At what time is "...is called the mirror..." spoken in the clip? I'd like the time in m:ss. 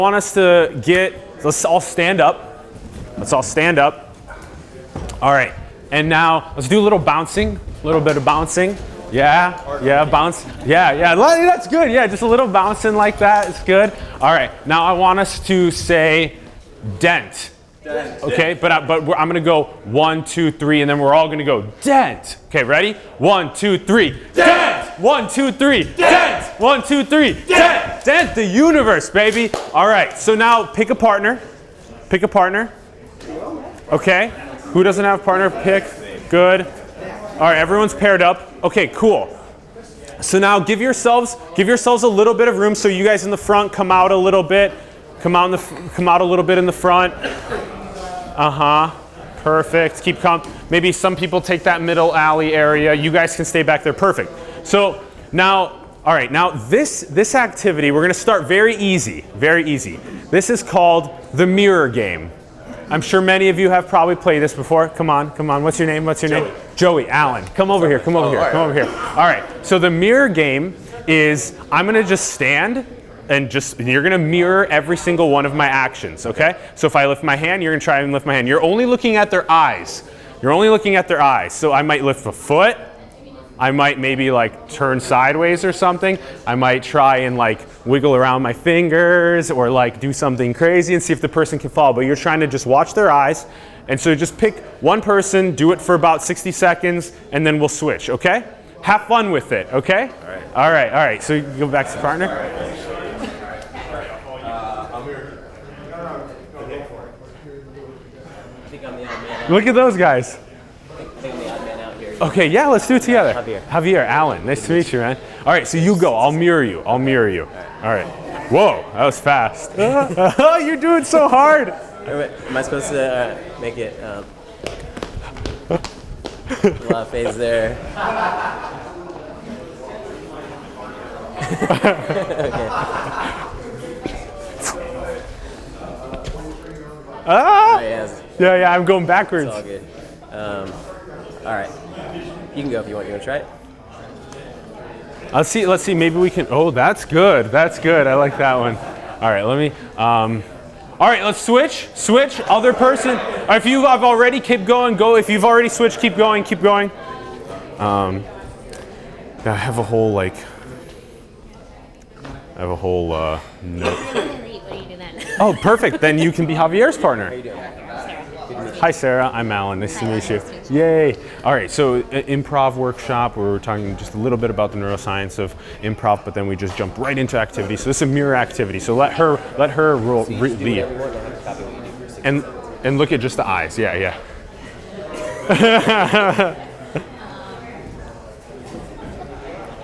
1:00.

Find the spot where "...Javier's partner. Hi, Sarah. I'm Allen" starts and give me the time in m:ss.
2:46.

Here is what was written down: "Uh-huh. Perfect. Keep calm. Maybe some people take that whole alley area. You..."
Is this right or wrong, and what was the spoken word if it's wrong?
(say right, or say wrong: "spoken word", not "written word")
wrong: "middle", not "whole".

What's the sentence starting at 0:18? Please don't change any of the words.
Okay, but, I, but I'm gonna go one, two, three, and then we're all gonna go dent.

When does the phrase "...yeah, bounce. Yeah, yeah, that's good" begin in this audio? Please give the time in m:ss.
0:09.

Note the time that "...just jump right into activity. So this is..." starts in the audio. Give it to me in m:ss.
2:56.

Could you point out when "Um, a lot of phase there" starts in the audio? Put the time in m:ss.
2:04.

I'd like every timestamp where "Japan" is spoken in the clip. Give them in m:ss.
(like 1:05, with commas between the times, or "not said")
not said.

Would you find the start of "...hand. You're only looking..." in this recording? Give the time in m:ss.
1:18.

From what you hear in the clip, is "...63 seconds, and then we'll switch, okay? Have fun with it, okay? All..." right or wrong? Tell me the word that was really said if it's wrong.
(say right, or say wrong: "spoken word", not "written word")
wrong: "60", not "63".